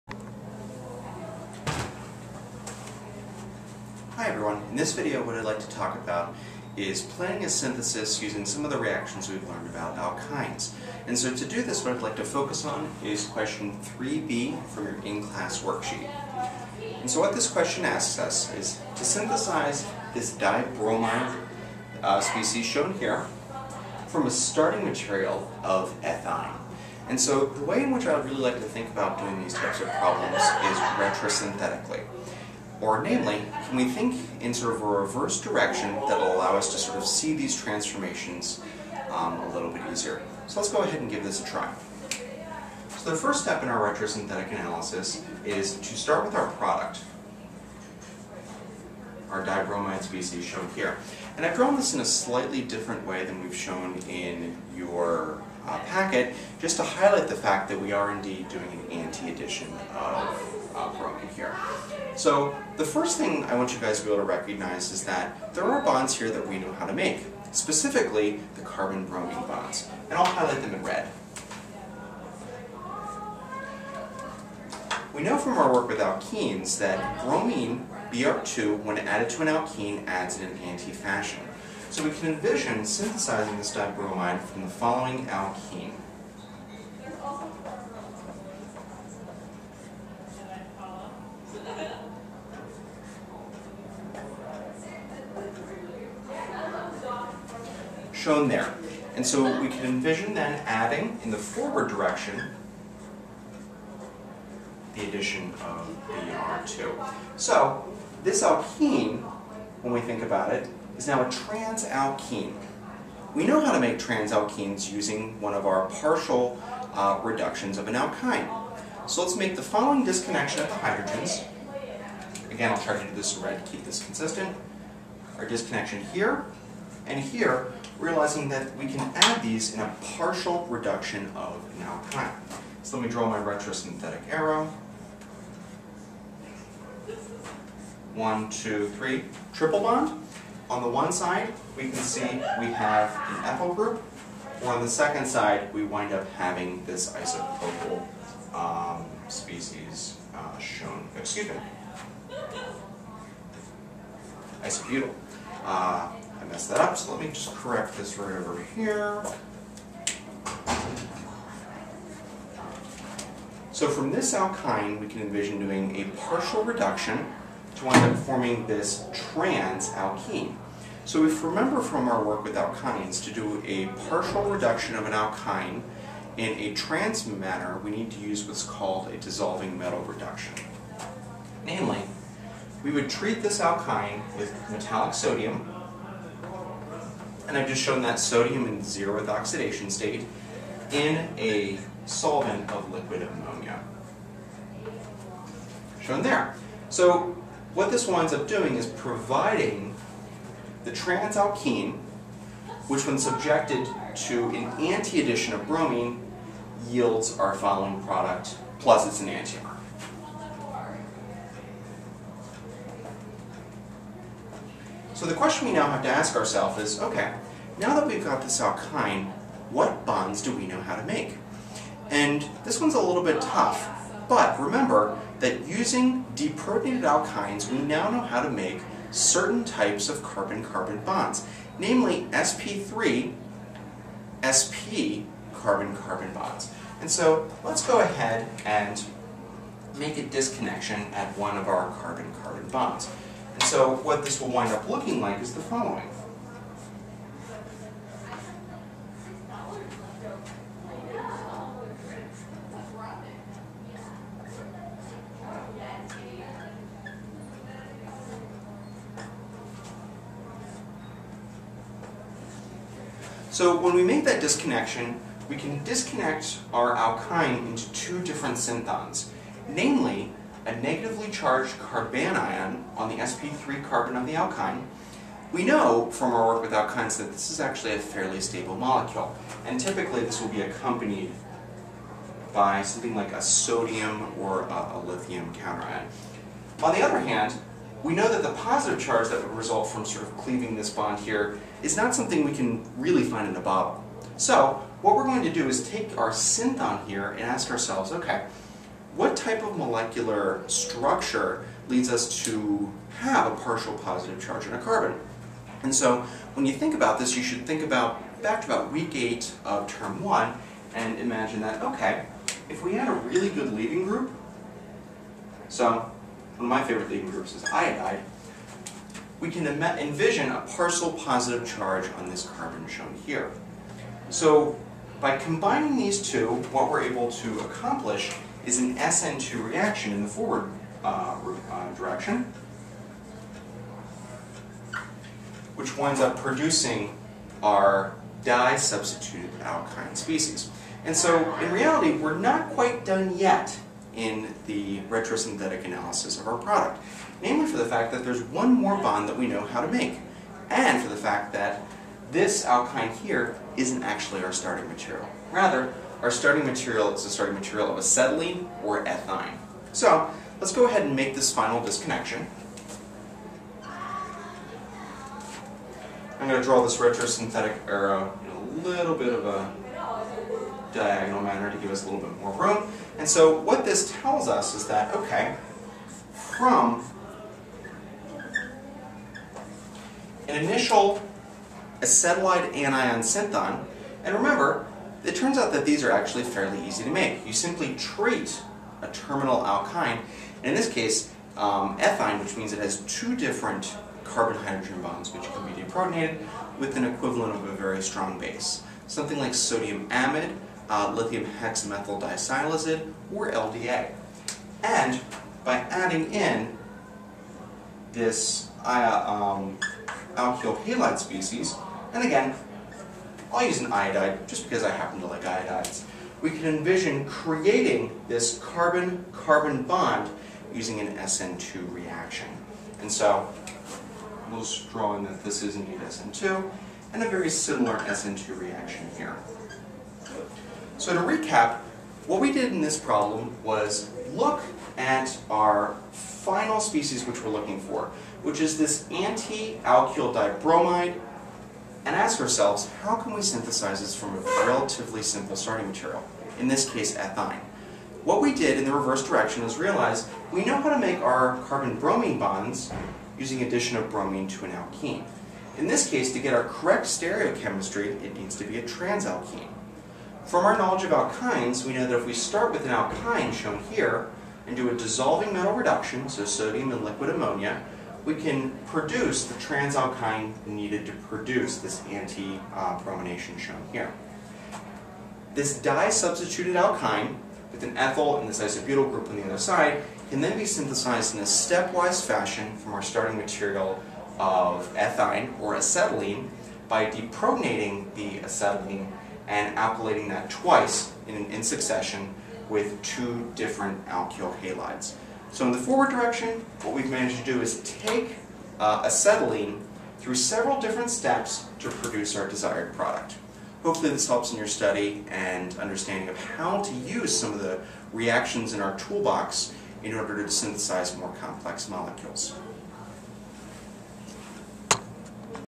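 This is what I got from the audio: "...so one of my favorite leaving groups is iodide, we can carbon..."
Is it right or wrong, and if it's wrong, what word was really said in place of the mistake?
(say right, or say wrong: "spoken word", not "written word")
wrong: "envision", not "carbon".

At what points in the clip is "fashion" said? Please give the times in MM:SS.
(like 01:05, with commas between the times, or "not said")
01:20, 08:02.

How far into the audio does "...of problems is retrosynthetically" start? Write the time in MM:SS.
00:29.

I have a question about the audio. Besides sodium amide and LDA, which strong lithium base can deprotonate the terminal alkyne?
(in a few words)
lithium hexamethyl disilazide.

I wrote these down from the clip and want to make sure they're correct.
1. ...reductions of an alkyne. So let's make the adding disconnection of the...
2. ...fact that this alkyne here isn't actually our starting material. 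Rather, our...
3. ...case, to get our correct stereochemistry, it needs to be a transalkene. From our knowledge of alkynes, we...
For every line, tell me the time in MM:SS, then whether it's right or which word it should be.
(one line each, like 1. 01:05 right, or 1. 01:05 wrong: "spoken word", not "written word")
1. 01:57 wrong: "following", not "adding"
2. 05:51 right
3. 07:36 right.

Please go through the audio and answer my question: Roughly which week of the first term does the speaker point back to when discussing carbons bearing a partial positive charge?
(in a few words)
week 8.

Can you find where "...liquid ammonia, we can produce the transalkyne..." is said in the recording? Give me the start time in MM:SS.
07:47.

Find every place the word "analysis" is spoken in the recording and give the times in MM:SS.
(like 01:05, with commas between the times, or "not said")
00:44, 05:45.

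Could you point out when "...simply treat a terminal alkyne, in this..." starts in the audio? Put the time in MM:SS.
06:27.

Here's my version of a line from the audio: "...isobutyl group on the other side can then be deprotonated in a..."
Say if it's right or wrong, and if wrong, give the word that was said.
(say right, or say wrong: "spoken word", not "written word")
wrong: "synthesized", not "deprotonated".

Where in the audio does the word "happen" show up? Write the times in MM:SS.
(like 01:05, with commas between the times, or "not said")
06:54.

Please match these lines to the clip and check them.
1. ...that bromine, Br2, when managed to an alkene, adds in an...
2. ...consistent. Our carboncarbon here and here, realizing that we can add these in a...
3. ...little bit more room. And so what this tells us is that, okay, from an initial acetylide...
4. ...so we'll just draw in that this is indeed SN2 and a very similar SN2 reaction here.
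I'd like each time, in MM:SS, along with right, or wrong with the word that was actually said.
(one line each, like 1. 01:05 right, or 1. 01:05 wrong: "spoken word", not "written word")
1. 01:16 wrong: "added", not "managed"
2. 02:04 wrong: "disconnection", not "carboncarbon"
3. 06:12 right
4. 07:03 right.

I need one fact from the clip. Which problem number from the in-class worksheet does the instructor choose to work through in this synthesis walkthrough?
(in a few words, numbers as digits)
3b.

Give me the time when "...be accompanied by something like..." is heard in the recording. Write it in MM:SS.
04:40.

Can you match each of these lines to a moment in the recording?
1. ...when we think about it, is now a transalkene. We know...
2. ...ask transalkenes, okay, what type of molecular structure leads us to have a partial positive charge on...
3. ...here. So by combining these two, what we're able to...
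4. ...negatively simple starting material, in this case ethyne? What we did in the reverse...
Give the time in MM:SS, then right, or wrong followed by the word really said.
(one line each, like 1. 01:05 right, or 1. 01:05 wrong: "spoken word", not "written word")
1. 01:49 right
2. 04:57 wrong: "ourselves", not "transalkenes"
3. 05:23 right
4. 07:24 wrong: "relatively", not "negatively".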